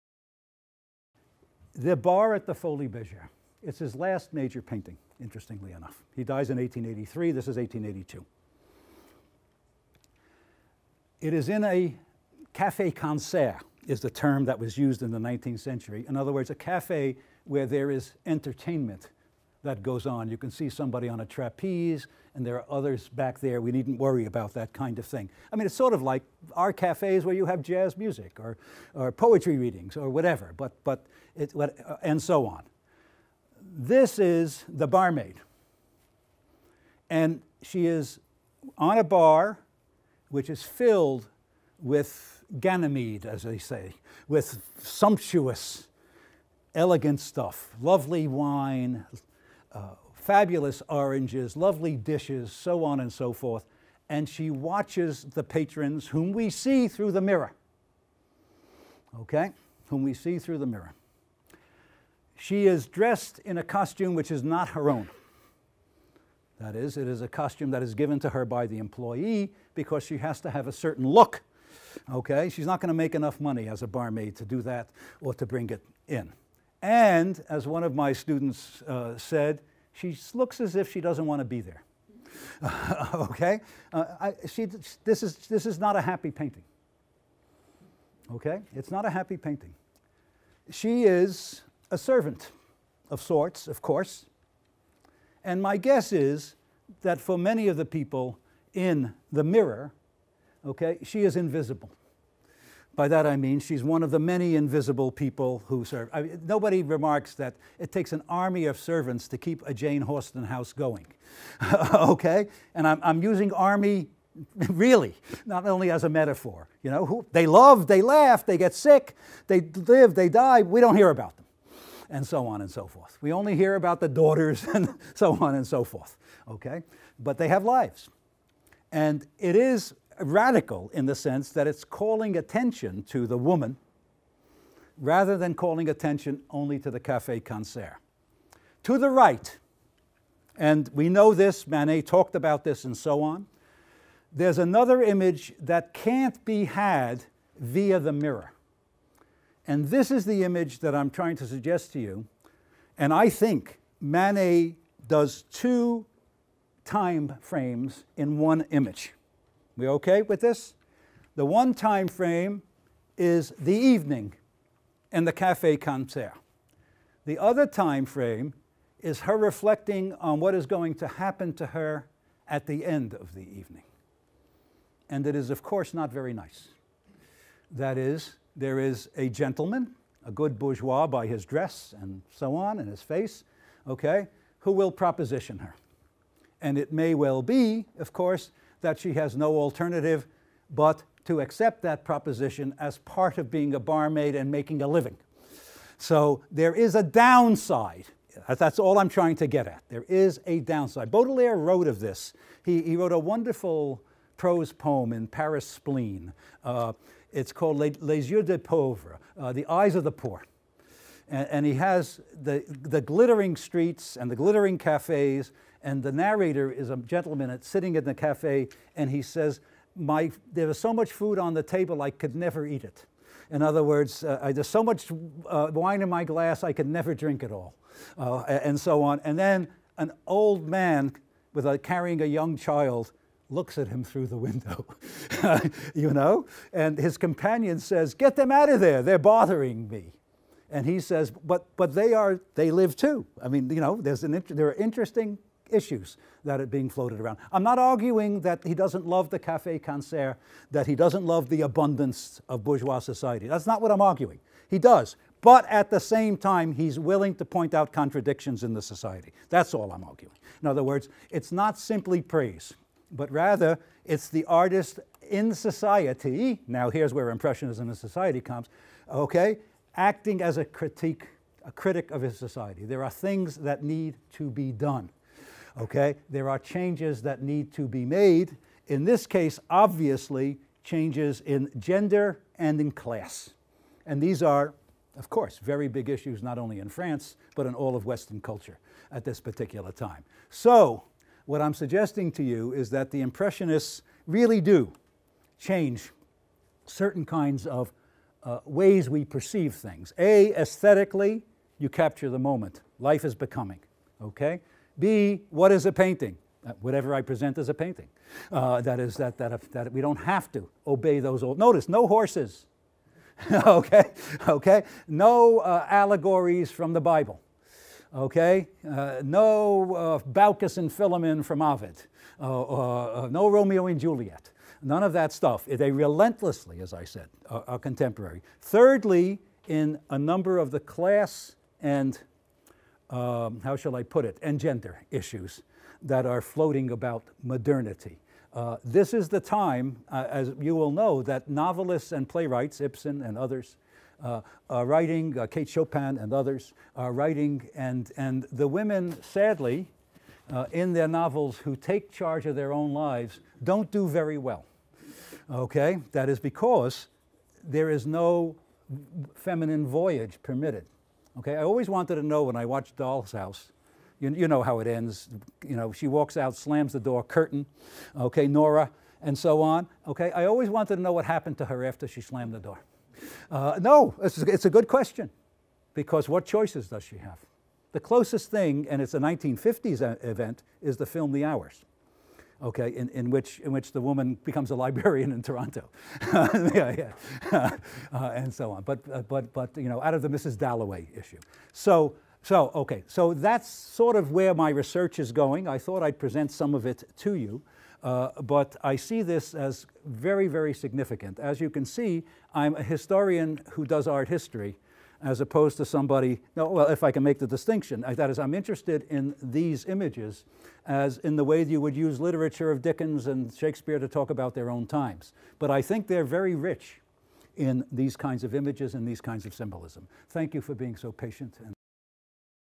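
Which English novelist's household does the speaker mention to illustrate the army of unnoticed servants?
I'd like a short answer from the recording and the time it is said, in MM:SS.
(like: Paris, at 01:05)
Jane Austen, at 01:49.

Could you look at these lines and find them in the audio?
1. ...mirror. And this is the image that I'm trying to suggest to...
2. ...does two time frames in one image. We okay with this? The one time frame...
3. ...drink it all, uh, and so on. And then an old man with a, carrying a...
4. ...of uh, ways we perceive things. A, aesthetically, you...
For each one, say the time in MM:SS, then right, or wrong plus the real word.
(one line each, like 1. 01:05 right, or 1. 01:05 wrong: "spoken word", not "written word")
1. 02:28 right
2. 02:35 right
3. 03:47 right
4. 04:57 right.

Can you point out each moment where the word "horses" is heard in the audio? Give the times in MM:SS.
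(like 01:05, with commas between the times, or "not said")
05:12.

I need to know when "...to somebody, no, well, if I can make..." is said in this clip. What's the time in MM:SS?
06:45.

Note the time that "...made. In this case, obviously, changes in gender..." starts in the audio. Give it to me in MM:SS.
04:38.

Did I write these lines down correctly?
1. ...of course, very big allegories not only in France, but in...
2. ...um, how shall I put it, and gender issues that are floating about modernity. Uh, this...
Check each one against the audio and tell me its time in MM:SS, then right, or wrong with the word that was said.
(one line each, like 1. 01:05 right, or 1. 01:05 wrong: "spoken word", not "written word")
1. 04:45 wrong: "issues", not "allegories"
2. 05:33 right.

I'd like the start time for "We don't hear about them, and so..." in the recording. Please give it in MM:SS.
02:00.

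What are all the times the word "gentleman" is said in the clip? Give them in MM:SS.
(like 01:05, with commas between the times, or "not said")
02:59, 03:36.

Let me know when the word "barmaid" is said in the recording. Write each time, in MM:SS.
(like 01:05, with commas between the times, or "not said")
00:34, 01:13, 03:13.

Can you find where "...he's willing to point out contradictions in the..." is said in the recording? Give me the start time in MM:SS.
04:16.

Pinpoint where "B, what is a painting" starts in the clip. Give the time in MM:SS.
05:04.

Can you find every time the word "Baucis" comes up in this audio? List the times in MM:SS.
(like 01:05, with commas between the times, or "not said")
05:20.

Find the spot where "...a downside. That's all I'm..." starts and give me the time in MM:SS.
03:16.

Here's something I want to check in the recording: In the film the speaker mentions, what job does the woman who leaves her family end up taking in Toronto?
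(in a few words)
librarian.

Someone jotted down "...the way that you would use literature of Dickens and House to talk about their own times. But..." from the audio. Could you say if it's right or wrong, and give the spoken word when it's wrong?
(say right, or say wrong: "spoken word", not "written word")
wrong: "Shakespeare", not "House".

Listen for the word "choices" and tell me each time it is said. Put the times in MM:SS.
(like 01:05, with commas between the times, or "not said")
06:16.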